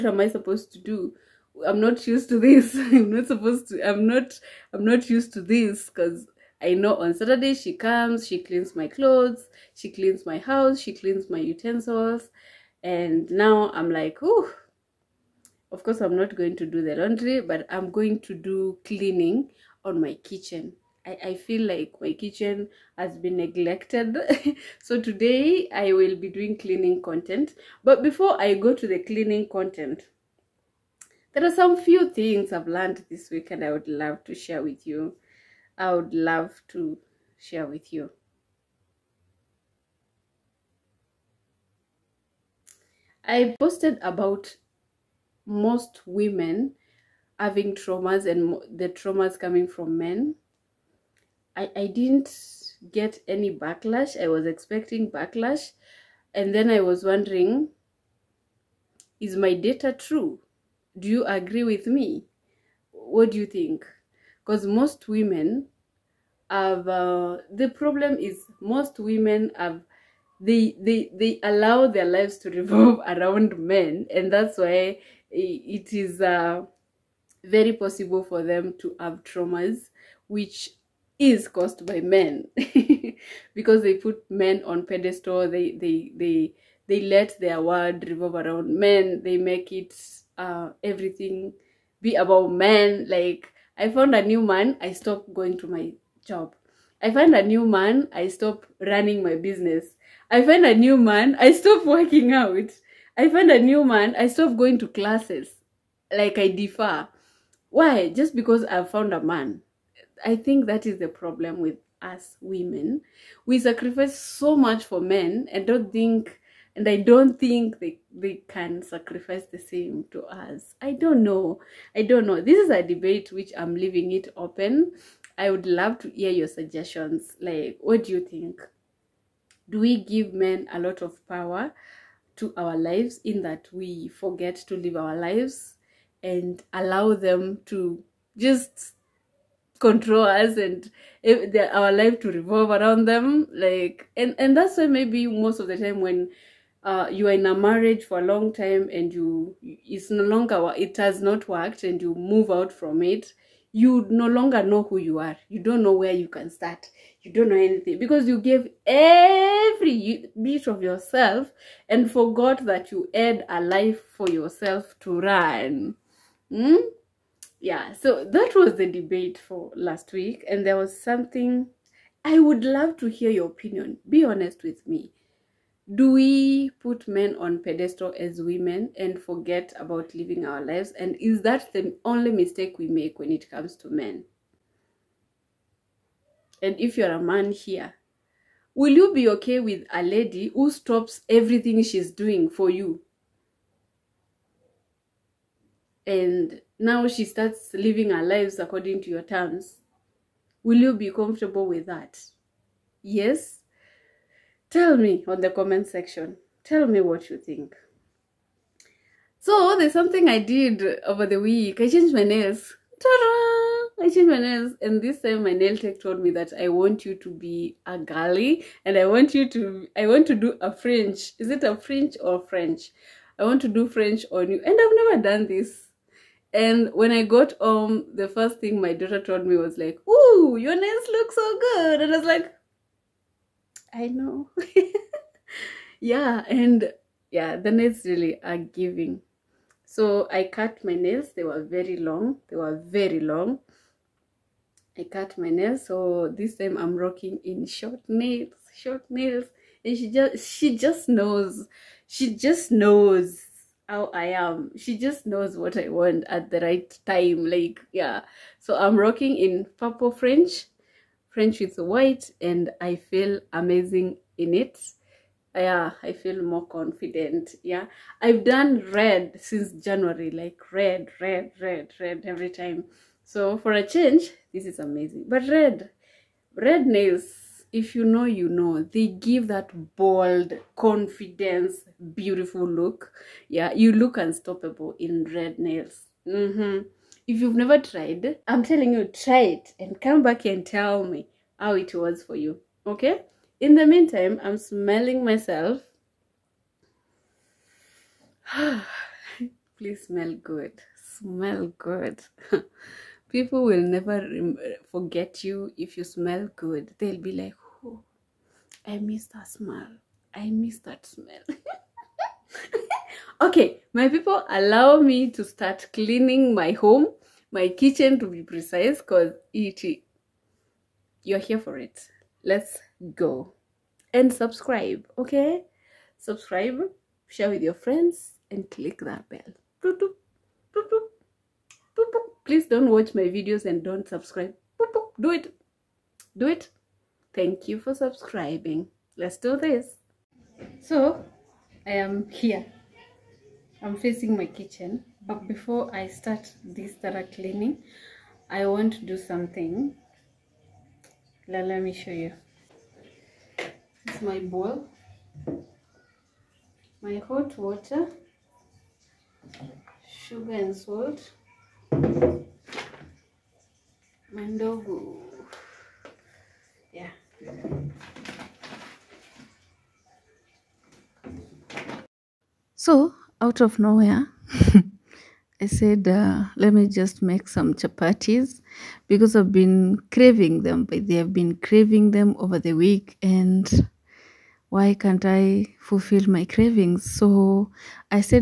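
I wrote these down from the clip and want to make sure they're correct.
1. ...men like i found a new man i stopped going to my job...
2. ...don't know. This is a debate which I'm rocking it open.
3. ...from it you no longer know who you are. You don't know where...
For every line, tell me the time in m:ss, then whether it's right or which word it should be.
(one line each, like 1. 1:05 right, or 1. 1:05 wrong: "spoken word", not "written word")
1. 1:32 right
2. 2:02 wrong: "leaving", not "rocking"
3. 2:32 right.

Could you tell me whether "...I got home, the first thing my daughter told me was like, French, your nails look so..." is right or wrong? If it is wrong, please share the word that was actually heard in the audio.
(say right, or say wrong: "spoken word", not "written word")
wrong: "Ooh", not "French".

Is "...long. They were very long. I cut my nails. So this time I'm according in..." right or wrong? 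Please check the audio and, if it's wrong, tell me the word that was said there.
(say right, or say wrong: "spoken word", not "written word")
wrong: "rocking", not "according".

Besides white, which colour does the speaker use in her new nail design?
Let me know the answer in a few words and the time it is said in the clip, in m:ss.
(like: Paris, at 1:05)
Purple, at 4:19.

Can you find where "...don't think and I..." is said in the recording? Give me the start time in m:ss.
1:55.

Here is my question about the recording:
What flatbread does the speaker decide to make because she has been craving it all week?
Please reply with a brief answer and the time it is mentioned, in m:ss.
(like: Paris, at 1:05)
Chapatis, at 6:17.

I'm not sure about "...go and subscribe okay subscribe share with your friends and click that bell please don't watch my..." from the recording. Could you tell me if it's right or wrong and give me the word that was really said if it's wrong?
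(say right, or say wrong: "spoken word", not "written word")
right.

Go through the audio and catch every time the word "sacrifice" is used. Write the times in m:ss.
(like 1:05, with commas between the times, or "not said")
1:53, 1:58.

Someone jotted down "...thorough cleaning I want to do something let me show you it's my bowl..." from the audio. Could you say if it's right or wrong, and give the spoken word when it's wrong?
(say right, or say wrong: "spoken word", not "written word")
right.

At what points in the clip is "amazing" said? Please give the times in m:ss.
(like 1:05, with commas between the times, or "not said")
4:23, 4:34.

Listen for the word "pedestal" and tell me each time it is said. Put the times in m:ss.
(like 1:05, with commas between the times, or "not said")
1:24, 2:57.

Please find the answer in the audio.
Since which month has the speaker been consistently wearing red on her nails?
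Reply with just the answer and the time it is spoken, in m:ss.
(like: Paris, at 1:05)
January, at 4:29.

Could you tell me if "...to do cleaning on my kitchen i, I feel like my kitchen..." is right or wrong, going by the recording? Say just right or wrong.
right.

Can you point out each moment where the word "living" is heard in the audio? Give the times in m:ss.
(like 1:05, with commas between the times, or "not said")
3:00, 3:17.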